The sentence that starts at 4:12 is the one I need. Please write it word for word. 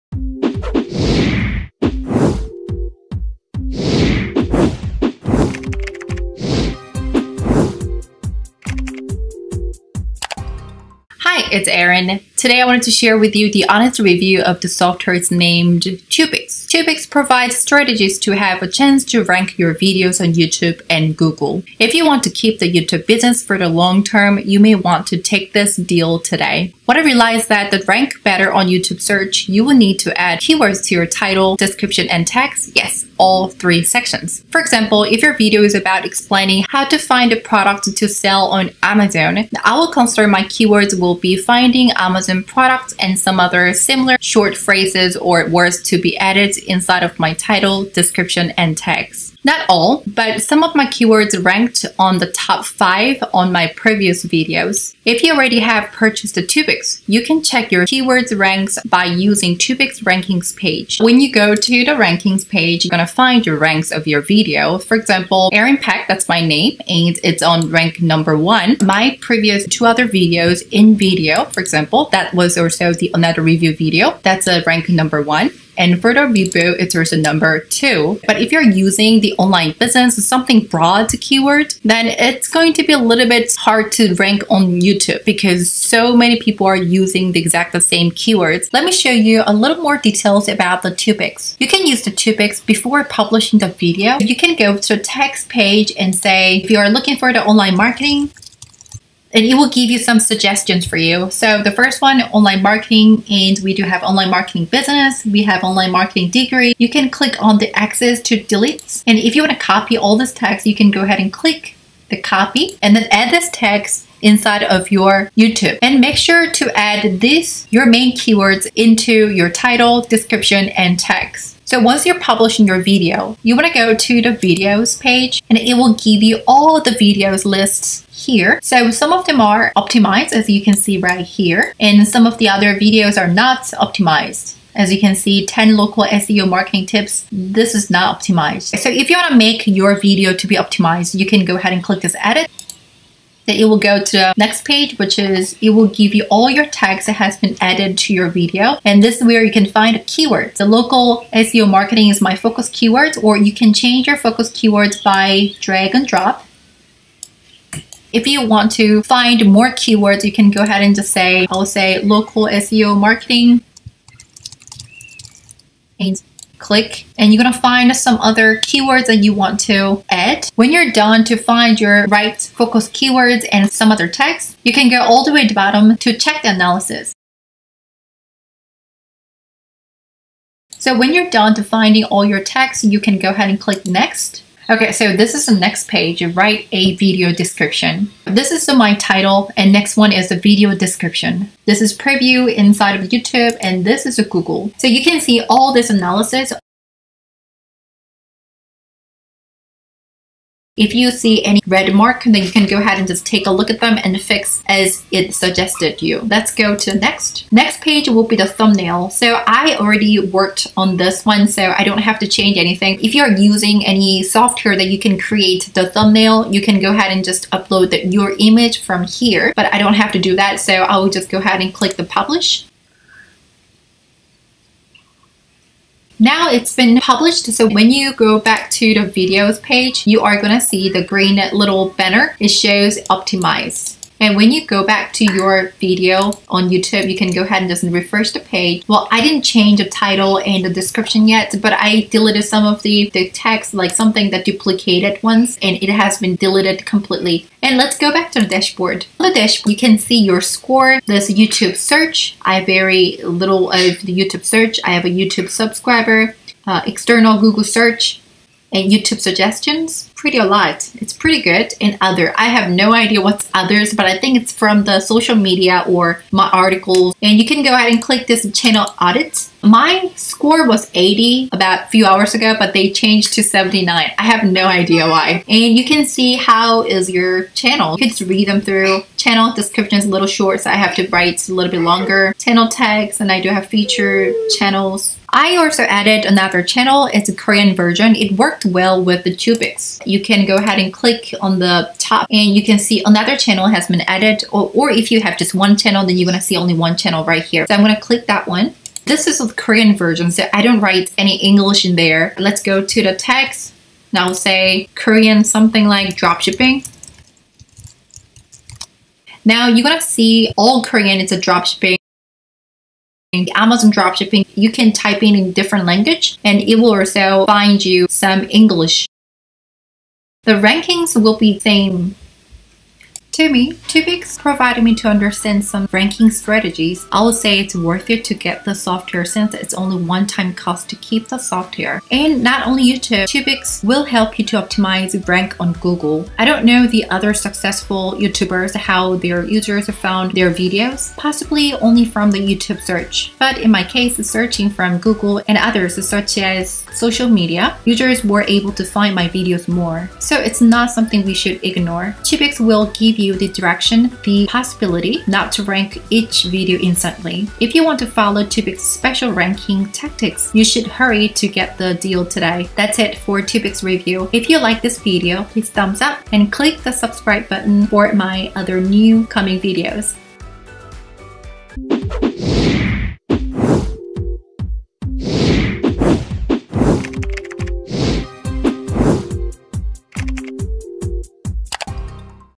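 I very little of the YouTube search.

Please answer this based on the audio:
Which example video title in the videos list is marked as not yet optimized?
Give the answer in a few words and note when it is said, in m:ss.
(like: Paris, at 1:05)
10 local SEO marketing tips, at 2:15.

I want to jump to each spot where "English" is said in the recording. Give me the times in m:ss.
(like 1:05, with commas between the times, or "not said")
5:01, 5:18.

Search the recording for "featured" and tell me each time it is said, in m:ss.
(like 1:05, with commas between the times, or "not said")
4:43.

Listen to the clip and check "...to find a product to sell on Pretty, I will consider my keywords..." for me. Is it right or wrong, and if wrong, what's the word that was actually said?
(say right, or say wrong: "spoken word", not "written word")
wrong: "Amazon", not "Pretty".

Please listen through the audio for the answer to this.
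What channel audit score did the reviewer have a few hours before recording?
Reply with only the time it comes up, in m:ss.
4:30.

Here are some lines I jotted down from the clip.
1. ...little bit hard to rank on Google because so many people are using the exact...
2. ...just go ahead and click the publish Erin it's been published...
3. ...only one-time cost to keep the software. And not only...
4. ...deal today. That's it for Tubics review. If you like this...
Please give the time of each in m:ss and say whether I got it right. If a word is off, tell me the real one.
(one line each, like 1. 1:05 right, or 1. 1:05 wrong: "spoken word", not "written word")
1. 1:22 wrong: "YouTube", not "Google"
2. 3:41 wrong: "Now", not "Erin"
3. 5:29 right
4. 6:01 right.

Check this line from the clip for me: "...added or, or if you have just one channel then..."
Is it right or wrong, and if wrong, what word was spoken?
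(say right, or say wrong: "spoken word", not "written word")
right.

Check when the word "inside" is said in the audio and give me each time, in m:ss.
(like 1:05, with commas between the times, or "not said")
0:46, 1:54, 3:12.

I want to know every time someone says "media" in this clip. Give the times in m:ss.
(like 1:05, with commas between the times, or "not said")
4:25, 5:47.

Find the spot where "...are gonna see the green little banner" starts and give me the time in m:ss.
3:50.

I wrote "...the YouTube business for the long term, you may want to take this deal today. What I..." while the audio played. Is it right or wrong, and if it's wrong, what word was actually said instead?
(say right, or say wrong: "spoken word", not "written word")
right.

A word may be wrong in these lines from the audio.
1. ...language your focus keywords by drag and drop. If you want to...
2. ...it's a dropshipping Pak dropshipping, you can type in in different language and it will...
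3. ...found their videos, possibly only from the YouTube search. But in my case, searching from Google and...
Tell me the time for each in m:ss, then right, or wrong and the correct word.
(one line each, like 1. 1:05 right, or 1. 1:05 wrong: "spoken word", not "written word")
1. 2:33 wrong: "change", not "language"
2. 5:11 wrong: "Amazon", not "Pak"
3. 5:39 right.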